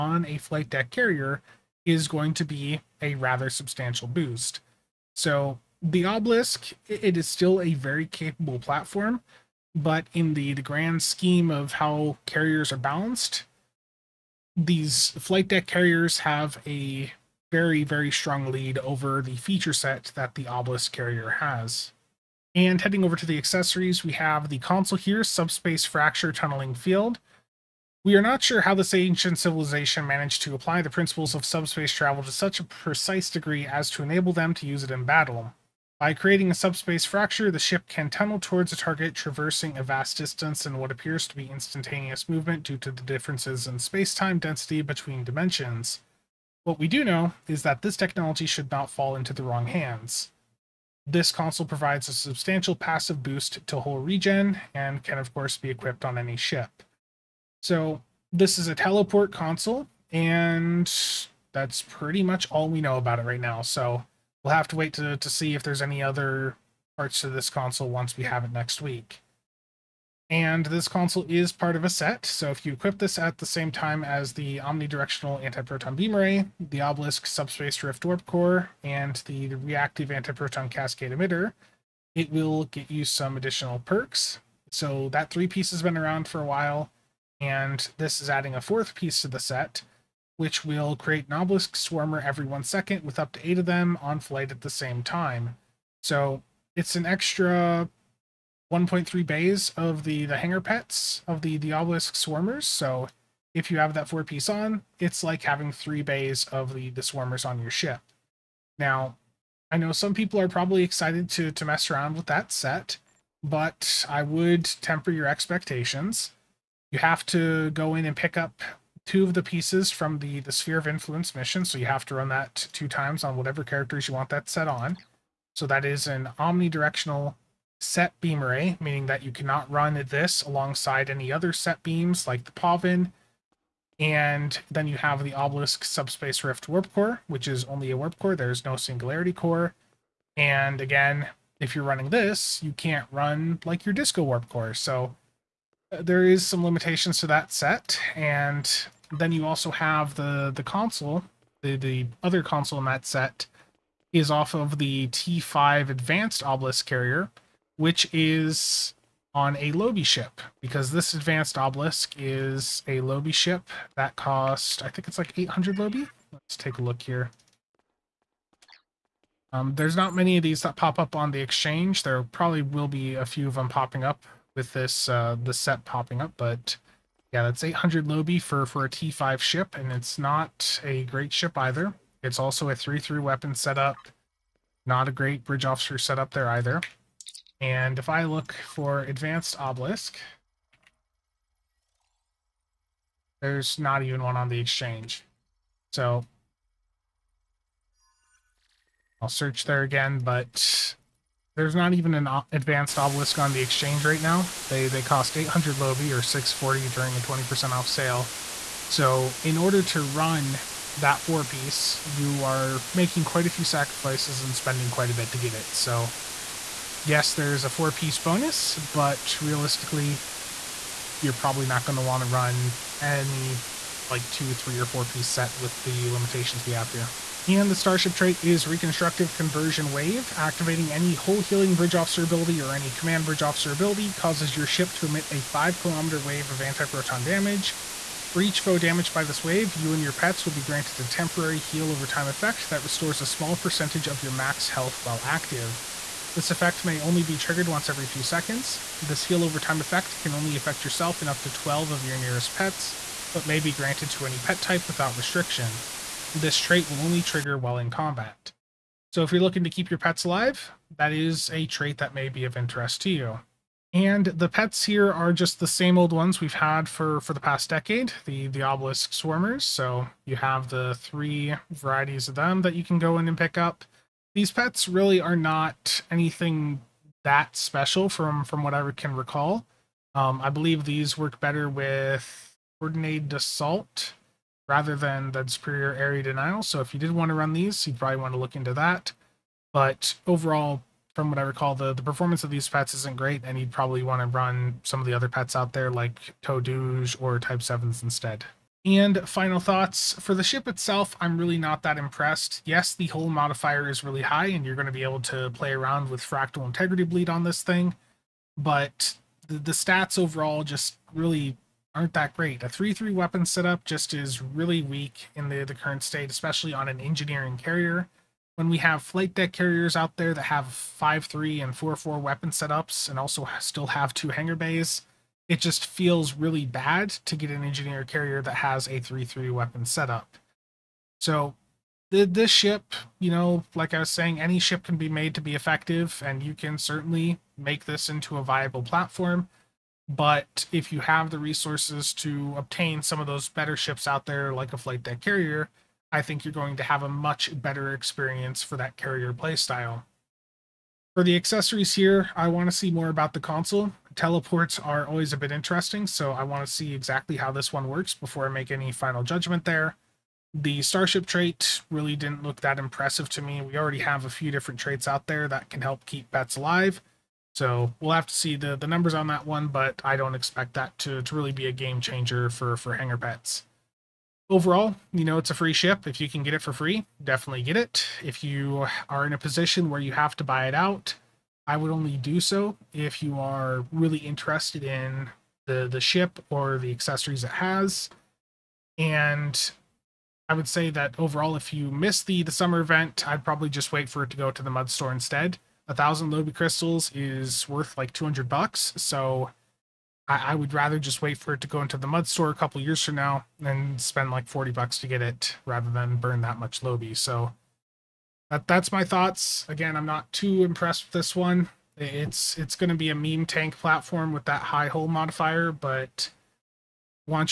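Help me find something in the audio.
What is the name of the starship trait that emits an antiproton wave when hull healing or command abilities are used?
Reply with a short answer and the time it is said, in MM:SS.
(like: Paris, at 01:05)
Reconstructive Conversion Wave, at 03:48.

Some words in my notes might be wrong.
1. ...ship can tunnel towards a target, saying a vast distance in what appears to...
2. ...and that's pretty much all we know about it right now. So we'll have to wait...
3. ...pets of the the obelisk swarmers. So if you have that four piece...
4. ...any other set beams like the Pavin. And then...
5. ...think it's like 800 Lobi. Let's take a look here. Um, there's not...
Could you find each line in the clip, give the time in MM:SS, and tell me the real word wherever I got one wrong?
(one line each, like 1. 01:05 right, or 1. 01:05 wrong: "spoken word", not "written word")
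1. 00:37 wrong: "traversing", not "saying"
2. 01:00 right
3. 01:40 right
4. 02:11 right
5. 02:44 right.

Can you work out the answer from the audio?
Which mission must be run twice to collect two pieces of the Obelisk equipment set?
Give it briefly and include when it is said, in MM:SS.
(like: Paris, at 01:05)
Sphere of Influence, at 02:00.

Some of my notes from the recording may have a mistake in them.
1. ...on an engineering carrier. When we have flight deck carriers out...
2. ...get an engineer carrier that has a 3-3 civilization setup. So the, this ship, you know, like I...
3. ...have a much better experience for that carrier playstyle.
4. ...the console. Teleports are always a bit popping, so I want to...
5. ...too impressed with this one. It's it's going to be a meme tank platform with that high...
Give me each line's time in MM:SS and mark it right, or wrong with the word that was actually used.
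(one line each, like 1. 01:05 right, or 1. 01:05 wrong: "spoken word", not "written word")
1. 05:16 right
2. 05:27 wrong: "weapon", not "civilization"
3. 05:46 right
4. 05:53 wrong: "interesting", not "popping"
5. 06:50 right.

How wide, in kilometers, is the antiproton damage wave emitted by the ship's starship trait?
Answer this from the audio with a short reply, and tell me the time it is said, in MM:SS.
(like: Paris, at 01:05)
5, at 03:55.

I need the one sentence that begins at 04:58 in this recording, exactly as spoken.
And final thoughts for the ship itself, I'm really not that impressed.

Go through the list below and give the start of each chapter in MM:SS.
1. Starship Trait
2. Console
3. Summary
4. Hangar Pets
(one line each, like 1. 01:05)
1. 03:46
2. 00:21
3. 04:58
4. 04:23.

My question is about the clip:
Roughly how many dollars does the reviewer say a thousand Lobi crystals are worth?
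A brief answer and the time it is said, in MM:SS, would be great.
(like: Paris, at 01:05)
200, at 06:38.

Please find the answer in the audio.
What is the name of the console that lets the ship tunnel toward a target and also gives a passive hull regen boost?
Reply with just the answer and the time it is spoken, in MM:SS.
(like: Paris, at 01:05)
Subspace Fracture Tunneling Field, at 00:25.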